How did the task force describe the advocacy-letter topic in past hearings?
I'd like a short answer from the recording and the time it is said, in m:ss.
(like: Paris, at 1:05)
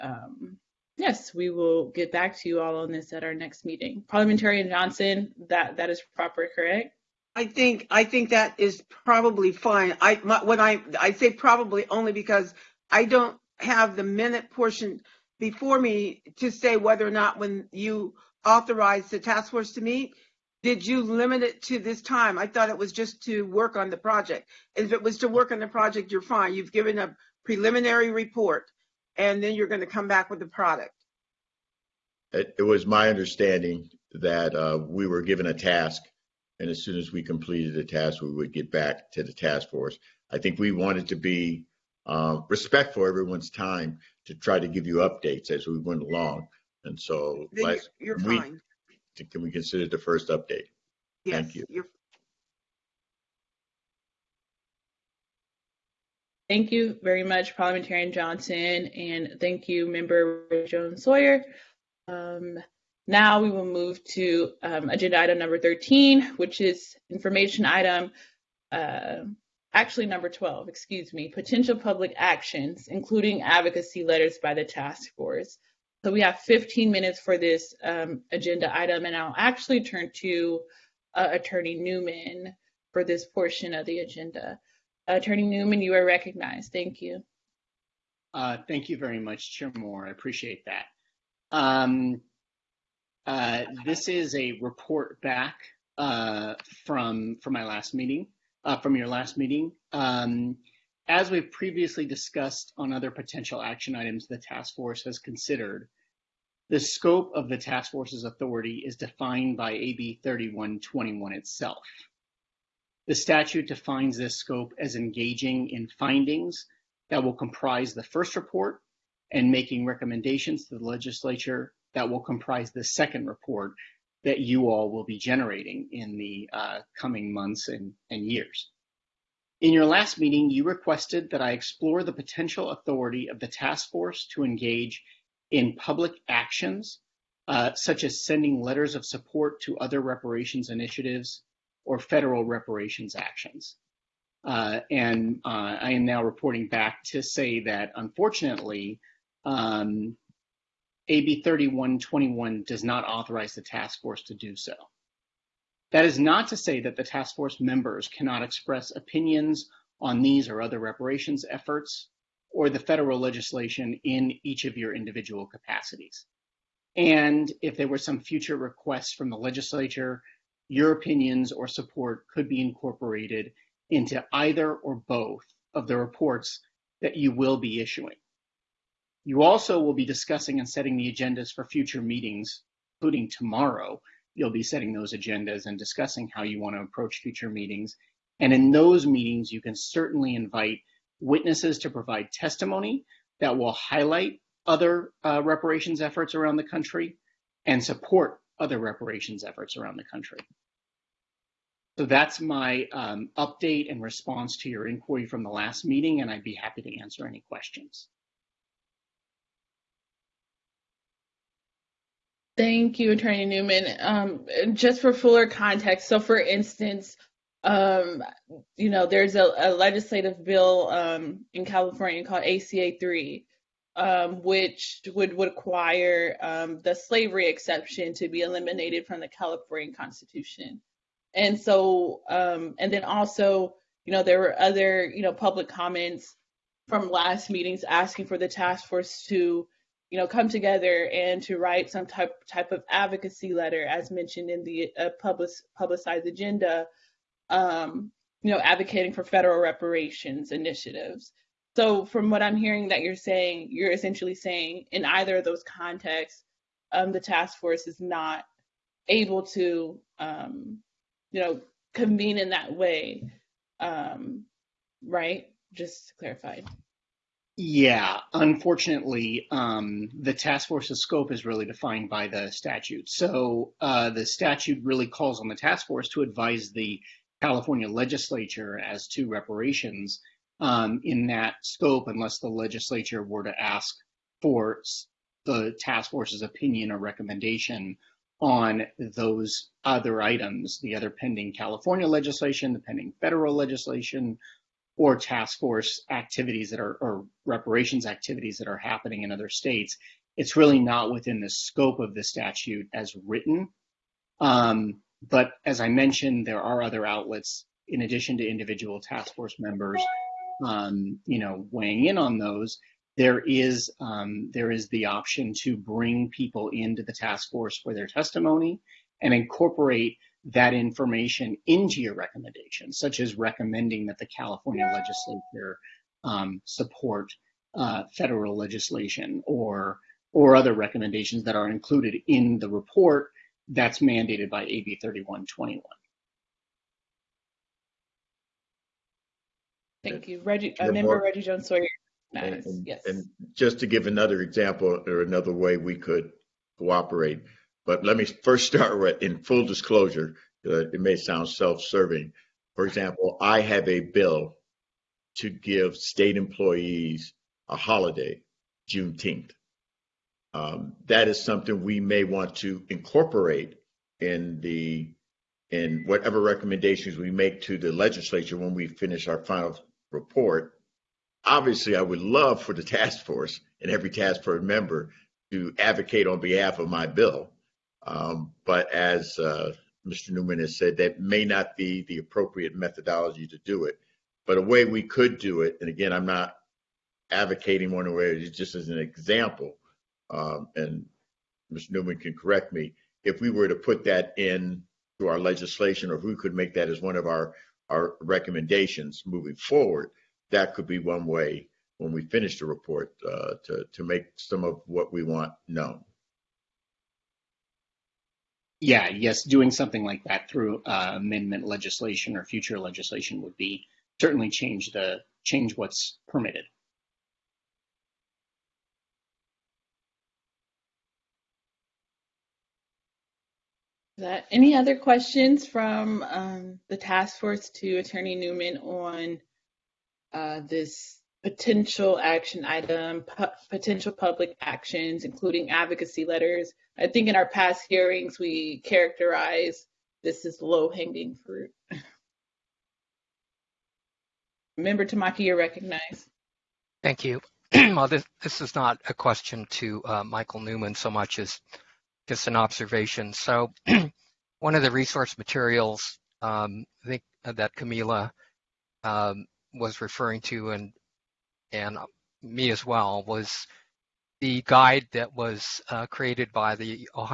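low hanging fruit, at 7:20.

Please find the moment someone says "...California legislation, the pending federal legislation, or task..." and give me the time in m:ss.
4:51.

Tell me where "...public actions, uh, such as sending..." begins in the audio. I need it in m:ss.
2:15.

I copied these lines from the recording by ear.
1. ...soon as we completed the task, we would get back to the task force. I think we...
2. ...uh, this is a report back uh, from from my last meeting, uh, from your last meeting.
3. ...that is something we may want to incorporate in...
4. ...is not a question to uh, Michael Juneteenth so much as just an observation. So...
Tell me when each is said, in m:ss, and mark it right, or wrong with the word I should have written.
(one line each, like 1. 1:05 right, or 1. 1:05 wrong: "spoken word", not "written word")
1. 0:36 right
2. 1:33 right
3. 6:01 right
4. 7:28 wrong: "Newman", not "Juneteenth".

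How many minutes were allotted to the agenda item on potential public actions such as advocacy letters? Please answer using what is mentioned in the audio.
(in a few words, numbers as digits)
15.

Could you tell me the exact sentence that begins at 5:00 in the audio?
It's really not within the scope of the statute as written.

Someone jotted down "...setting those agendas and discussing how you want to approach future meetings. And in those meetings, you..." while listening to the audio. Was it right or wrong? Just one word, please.
right.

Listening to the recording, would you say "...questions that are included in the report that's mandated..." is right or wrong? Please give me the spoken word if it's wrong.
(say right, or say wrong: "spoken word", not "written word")
wrong: "recommendations", not "questions".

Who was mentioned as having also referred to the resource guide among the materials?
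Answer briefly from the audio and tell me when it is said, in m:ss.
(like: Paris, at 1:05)
Camila, at 7:37.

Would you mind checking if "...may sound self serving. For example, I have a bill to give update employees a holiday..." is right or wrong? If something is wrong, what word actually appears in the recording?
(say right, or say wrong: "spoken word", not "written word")
wrong: "state", not "update".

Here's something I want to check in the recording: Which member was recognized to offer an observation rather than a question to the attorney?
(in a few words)
Tamaki.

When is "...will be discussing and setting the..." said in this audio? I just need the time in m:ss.
2:59.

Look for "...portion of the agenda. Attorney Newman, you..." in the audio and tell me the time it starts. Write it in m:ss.
1:23.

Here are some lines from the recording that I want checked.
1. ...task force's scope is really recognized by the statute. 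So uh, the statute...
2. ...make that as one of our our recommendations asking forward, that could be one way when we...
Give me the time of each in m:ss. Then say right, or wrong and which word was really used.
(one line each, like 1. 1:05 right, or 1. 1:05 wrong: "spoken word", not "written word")
1. 4:30 wrong: "defined", not "recognized"
2. 6:36 wrong: "moving", not "asking".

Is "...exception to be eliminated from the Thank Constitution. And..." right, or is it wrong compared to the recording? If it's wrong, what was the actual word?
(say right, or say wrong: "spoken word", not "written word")
wrong: "California", not "Thank".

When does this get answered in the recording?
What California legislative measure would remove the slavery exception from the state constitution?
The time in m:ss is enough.
3:42.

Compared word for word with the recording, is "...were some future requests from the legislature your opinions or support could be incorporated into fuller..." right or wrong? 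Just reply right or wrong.
wrong.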